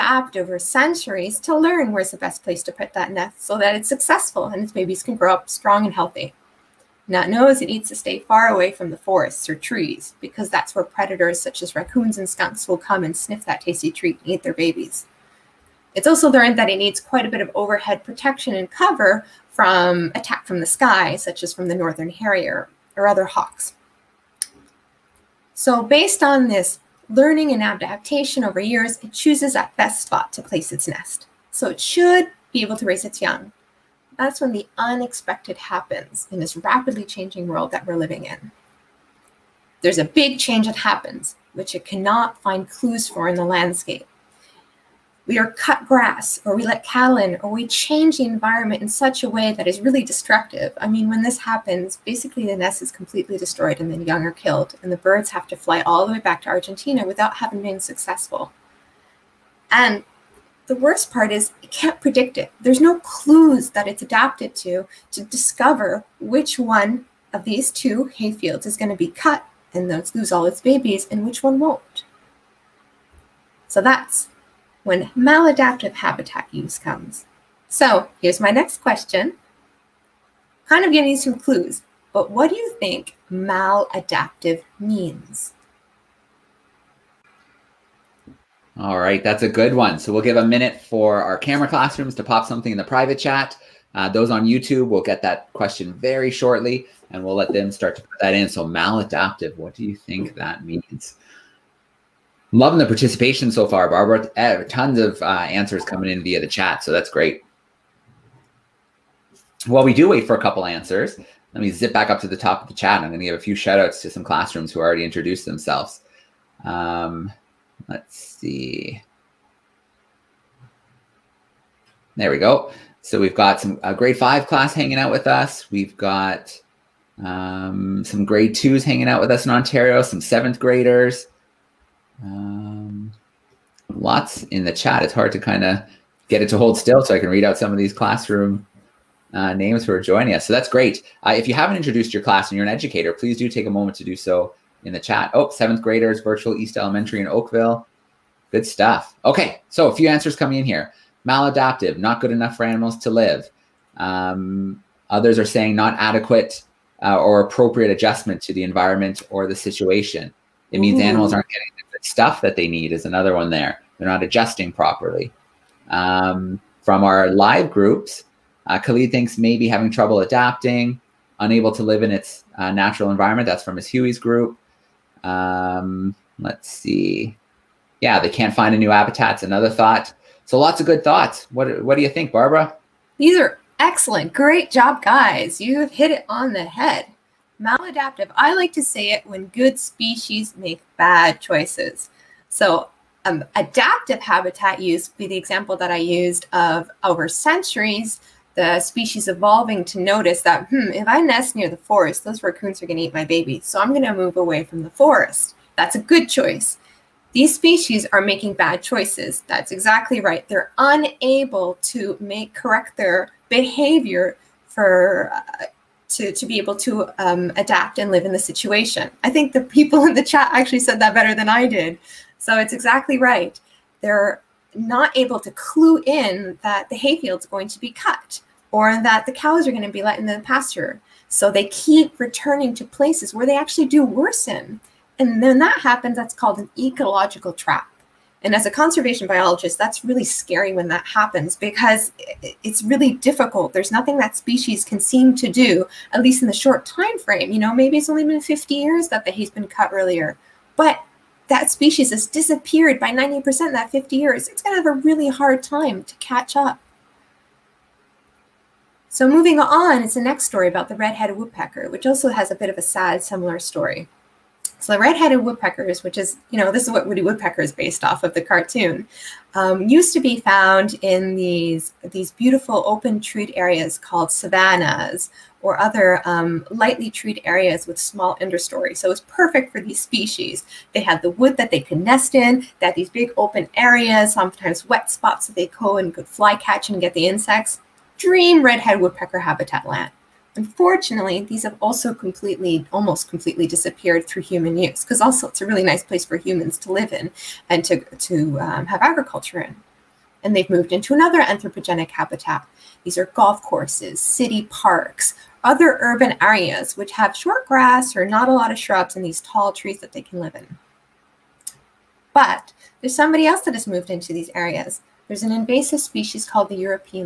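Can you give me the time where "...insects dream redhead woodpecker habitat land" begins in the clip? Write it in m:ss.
4:47.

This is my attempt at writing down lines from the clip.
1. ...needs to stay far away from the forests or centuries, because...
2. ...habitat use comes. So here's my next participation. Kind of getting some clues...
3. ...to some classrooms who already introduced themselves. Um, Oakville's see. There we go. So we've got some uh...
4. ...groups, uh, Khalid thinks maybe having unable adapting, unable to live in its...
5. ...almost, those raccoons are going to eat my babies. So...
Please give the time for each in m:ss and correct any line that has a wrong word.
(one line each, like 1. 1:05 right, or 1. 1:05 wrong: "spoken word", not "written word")
1. 0:07 wrong: "trees", not "centuries"
2. 1:15 wrong: "question", not "participation"
3. 1:54 wrong: "Let", not "Oakville"
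4. 2:47 wrong: "trouble", not "unable"
5. 3:21 wrong: "forest", not "almost".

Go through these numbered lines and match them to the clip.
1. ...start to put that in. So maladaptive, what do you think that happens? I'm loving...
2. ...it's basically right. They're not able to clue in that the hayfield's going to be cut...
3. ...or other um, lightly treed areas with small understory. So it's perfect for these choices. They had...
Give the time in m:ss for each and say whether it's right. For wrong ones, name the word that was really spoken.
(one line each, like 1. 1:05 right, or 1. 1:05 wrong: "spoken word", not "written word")
1. 1:37 wrong: "means", not "happens"
2. 3:42 wrong: "exactly", not "basically"
3. 4:35 wrong: "species", not "choices".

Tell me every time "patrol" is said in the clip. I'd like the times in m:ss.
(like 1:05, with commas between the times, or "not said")
not said.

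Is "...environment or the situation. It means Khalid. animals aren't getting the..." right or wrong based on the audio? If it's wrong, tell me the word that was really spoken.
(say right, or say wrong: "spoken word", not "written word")
wrong: "Ooh", not "Khalid".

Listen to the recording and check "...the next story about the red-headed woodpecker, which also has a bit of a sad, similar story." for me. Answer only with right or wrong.
right.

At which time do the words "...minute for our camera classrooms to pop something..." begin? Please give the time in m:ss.
1:30.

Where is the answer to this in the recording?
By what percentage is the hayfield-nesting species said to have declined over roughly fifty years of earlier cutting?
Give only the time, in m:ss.
4:13.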